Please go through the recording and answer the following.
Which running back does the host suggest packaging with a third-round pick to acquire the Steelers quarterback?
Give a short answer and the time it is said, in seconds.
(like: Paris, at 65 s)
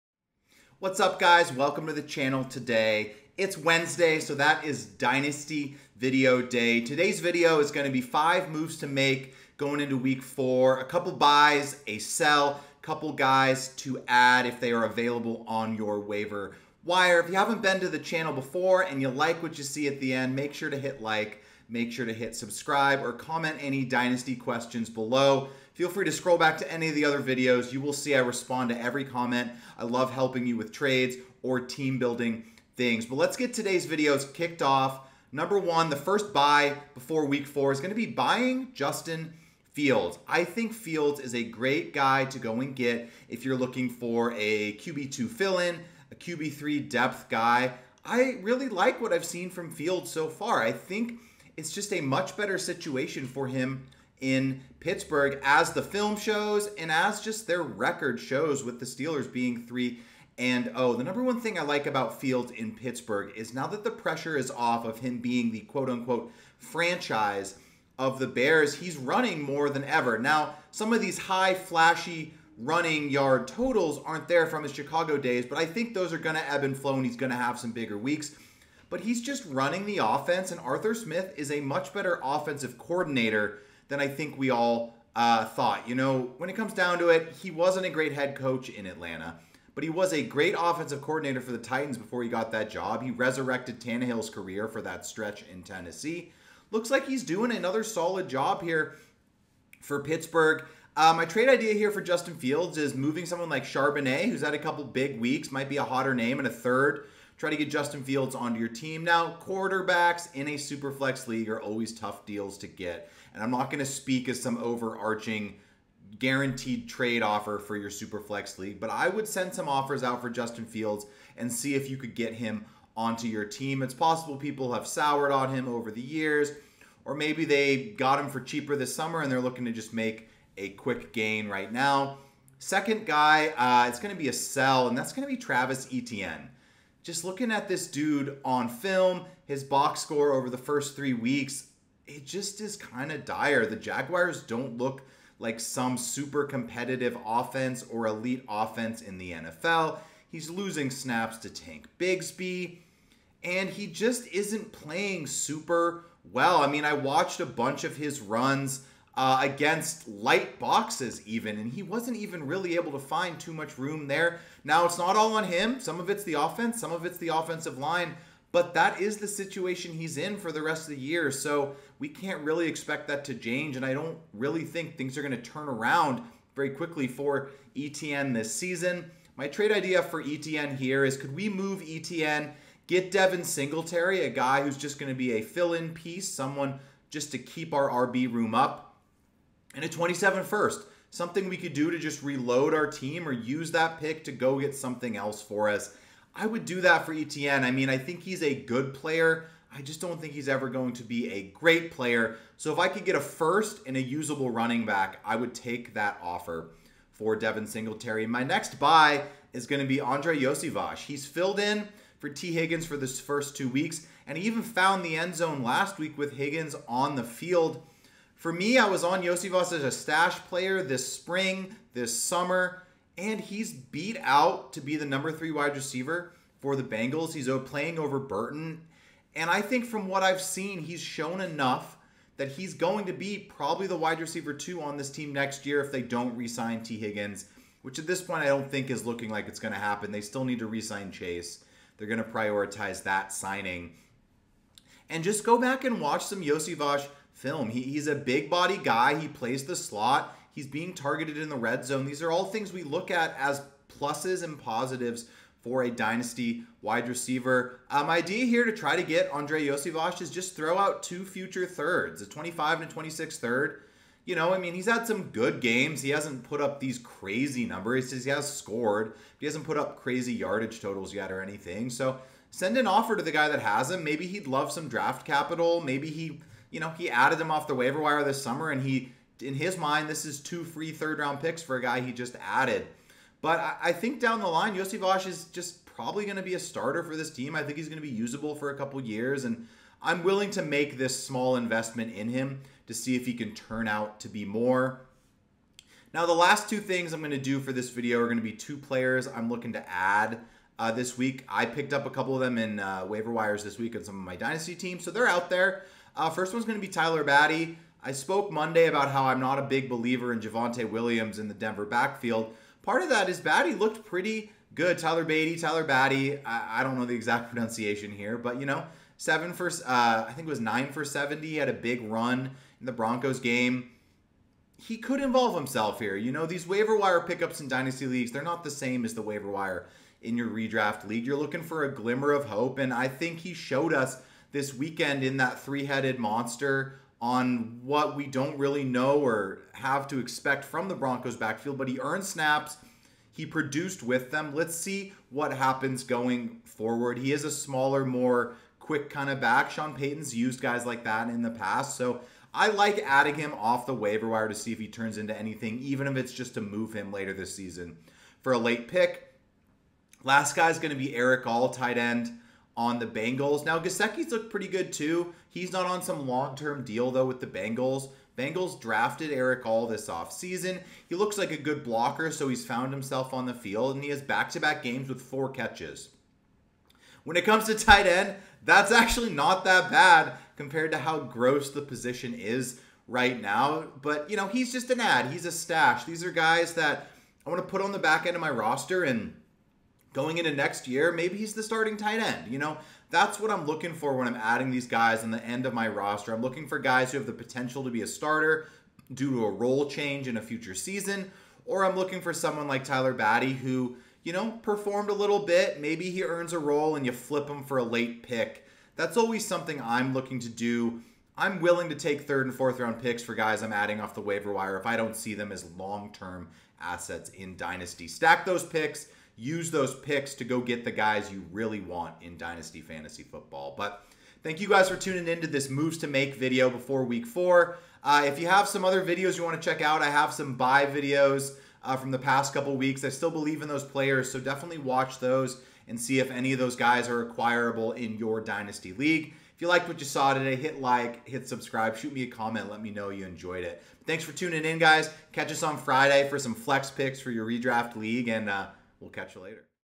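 Charbonnet, at 103 s.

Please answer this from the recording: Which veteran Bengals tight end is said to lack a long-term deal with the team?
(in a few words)
Gesicki.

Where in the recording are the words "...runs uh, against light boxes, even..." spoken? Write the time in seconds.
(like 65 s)
158 s.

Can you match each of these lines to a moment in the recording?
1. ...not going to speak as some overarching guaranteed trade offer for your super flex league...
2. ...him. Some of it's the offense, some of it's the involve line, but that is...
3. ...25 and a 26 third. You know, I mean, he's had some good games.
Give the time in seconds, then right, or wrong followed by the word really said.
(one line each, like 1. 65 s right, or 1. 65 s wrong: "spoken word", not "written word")
1. 113 s right
2. 165 s wrong: "offensive", not "involve"
3. 262 s right.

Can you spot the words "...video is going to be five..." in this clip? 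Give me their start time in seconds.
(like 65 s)
7 s.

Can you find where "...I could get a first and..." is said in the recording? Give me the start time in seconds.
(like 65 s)
202 s.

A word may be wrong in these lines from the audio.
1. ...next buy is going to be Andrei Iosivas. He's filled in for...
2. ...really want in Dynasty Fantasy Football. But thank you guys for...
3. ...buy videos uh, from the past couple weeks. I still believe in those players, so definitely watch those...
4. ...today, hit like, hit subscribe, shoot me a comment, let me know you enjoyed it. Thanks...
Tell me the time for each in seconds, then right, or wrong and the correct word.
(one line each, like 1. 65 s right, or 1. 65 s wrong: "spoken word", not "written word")
1. 208 s right
2. 421 s right
3. 430 s right
4. 440 s right.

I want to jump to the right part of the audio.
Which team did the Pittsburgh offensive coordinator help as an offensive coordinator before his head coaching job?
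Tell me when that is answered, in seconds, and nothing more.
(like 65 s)
91 s.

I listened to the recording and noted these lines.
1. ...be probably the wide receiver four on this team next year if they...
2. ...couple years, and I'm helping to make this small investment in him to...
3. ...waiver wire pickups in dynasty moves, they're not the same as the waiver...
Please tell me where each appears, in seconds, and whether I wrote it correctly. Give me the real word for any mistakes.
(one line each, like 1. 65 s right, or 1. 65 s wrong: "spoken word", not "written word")
1. 233 s wrong: "two", not "four"
2. 288 s wrong: "willing", not "helping"
3. 326 s wrong: "leagues", not "moves".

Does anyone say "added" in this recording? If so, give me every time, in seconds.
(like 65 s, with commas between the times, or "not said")
277 s, 282 s.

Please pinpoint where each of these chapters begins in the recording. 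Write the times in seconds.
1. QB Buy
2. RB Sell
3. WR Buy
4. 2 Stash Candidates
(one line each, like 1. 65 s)
1. 38 s
2. 136 s
3. 210 s
4. 307 s.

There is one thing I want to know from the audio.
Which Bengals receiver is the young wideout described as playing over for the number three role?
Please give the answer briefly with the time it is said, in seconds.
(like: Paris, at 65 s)
Burton, at 228 s.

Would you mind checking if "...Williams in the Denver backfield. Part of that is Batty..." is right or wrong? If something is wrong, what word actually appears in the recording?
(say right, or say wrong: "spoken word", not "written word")
right.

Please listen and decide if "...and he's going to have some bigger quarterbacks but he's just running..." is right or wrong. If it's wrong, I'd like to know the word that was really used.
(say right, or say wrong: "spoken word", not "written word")
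wrong: "weeks", not "quarterbacks".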